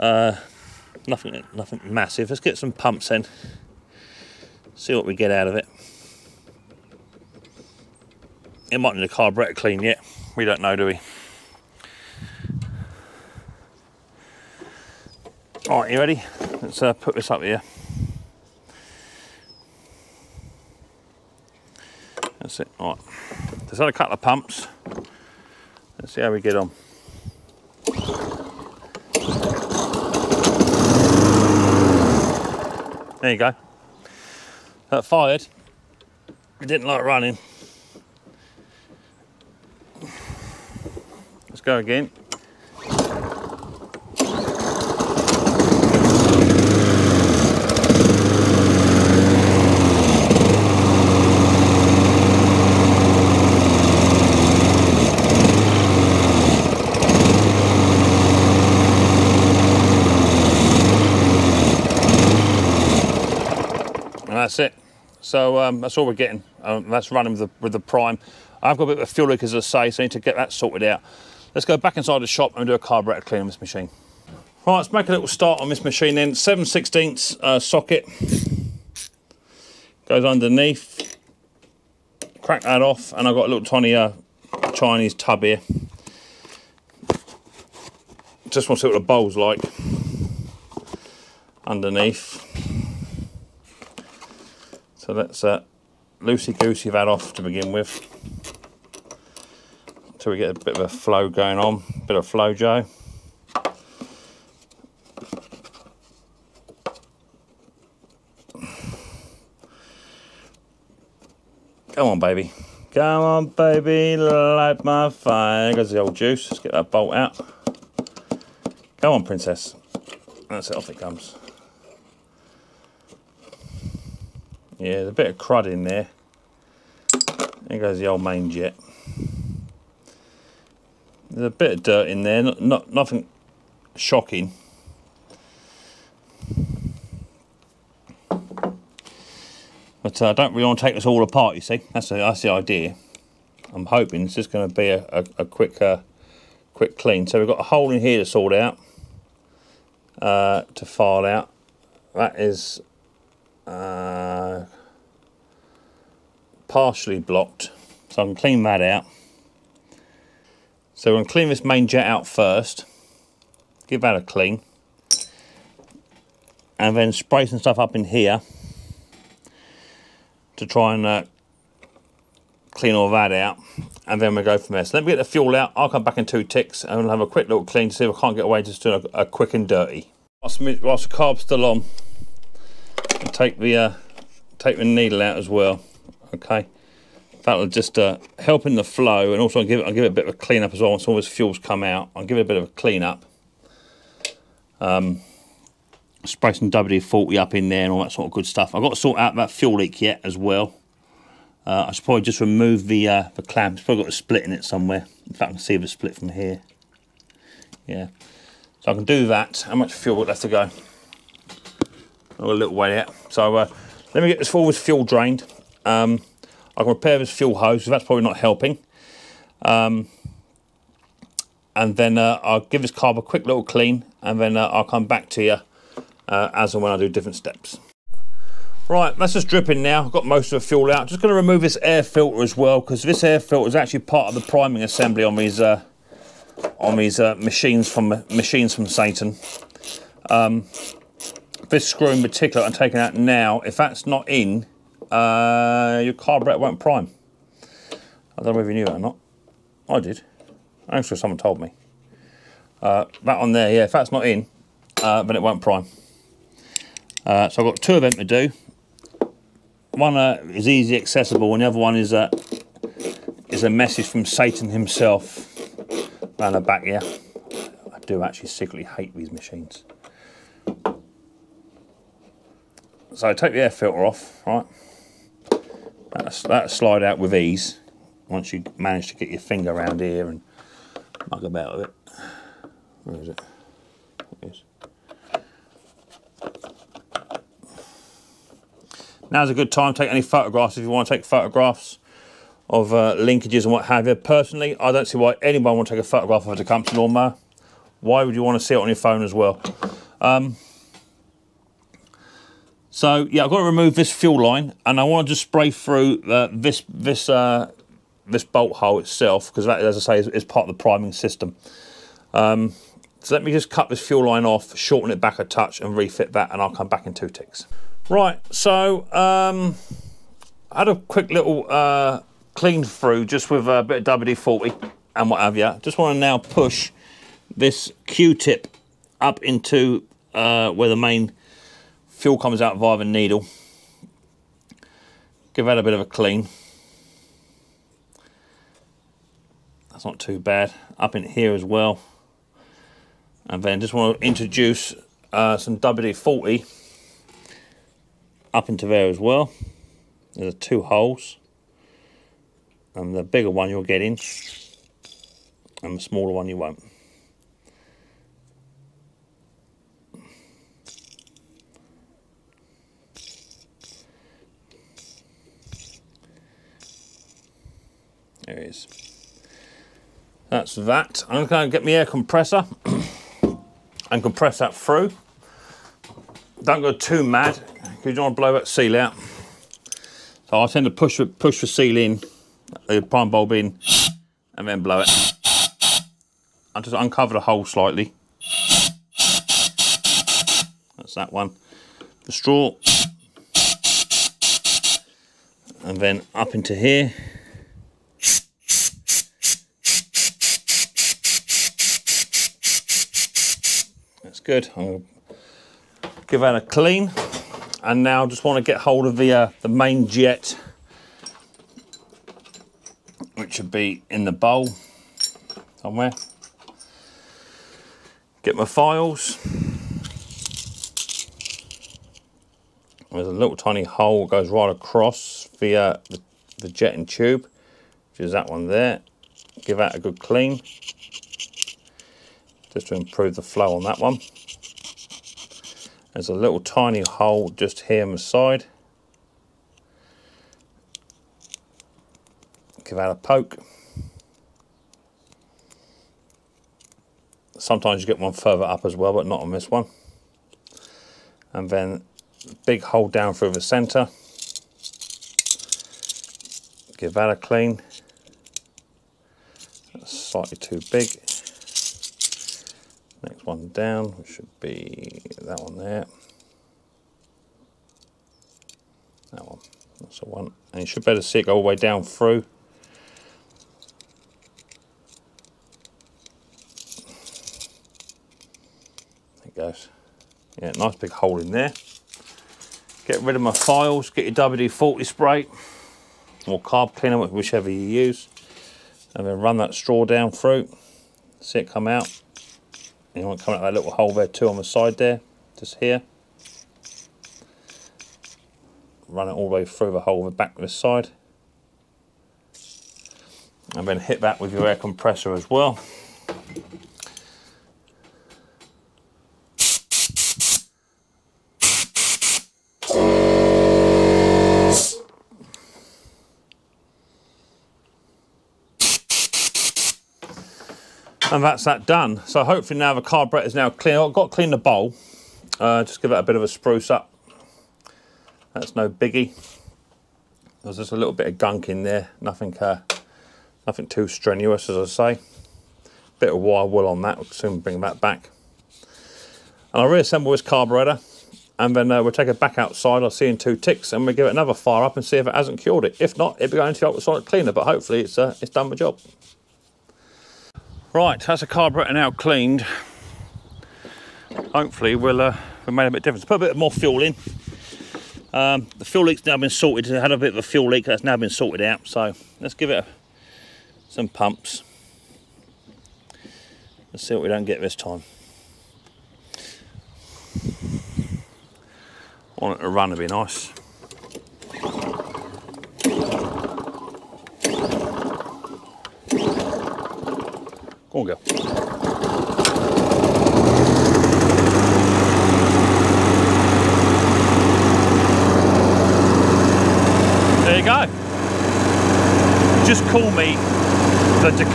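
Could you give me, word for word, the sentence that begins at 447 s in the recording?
Sometimes you get one further up as well, but not on this one.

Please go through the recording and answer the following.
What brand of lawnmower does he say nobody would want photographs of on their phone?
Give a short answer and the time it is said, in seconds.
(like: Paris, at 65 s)
Tecumseh, at 296 s.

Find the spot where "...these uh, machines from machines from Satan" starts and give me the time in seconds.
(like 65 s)
236 s.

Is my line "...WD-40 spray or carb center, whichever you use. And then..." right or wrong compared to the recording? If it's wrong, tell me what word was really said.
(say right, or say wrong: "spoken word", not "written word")
wrong: "cleaner", not "center".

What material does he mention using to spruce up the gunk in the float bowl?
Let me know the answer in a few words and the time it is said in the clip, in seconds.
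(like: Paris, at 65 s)
wire wool, at 536 s.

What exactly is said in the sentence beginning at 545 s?
If not, it'll be going to the ultrasonic cleaner, but hopefully it's uh, it's done the job.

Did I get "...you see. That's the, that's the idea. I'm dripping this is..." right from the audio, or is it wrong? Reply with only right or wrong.
wrong.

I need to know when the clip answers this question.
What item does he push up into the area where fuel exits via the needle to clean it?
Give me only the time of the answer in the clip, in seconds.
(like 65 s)
328 s.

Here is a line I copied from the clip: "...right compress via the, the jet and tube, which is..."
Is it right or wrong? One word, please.
wrong.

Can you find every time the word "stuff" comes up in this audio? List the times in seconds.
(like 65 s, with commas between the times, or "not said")
167 s, 198 s.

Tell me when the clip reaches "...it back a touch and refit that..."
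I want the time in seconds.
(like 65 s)
315 s.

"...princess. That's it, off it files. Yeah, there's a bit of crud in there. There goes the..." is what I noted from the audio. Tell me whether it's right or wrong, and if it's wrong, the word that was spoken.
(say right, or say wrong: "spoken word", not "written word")
wrong: "comes", not "files".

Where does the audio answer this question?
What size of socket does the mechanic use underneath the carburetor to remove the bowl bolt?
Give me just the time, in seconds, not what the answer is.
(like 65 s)
76 s.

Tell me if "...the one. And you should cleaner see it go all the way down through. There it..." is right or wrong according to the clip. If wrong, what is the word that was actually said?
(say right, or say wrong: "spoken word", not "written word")
wrong: "better", not "cleaner".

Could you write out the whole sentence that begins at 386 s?
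I just uncover the hole slightly.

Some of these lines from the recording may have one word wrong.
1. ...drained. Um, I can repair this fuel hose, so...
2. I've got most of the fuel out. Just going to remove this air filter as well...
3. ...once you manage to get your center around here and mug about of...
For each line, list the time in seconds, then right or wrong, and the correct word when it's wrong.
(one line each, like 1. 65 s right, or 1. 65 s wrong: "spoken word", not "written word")
1. 215 s right
2. 230 s right
3. 278 s wrong: "finger", not "center".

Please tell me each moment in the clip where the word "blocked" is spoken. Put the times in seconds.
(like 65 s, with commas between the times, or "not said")
157 s.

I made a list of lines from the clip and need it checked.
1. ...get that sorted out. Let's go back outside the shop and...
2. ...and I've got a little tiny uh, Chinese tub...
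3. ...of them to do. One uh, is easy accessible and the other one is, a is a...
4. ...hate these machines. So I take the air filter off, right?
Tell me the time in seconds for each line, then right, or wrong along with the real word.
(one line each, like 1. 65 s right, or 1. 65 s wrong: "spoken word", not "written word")
1. 70 s wrong: "inside", not "outside"
2. 83 s right
3. 257 s right
4. 268 s right.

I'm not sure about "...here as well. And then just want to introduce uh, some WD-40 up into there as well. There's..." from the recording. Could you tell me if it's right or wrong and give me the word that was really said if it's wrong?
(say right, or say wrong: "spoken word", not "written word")
right.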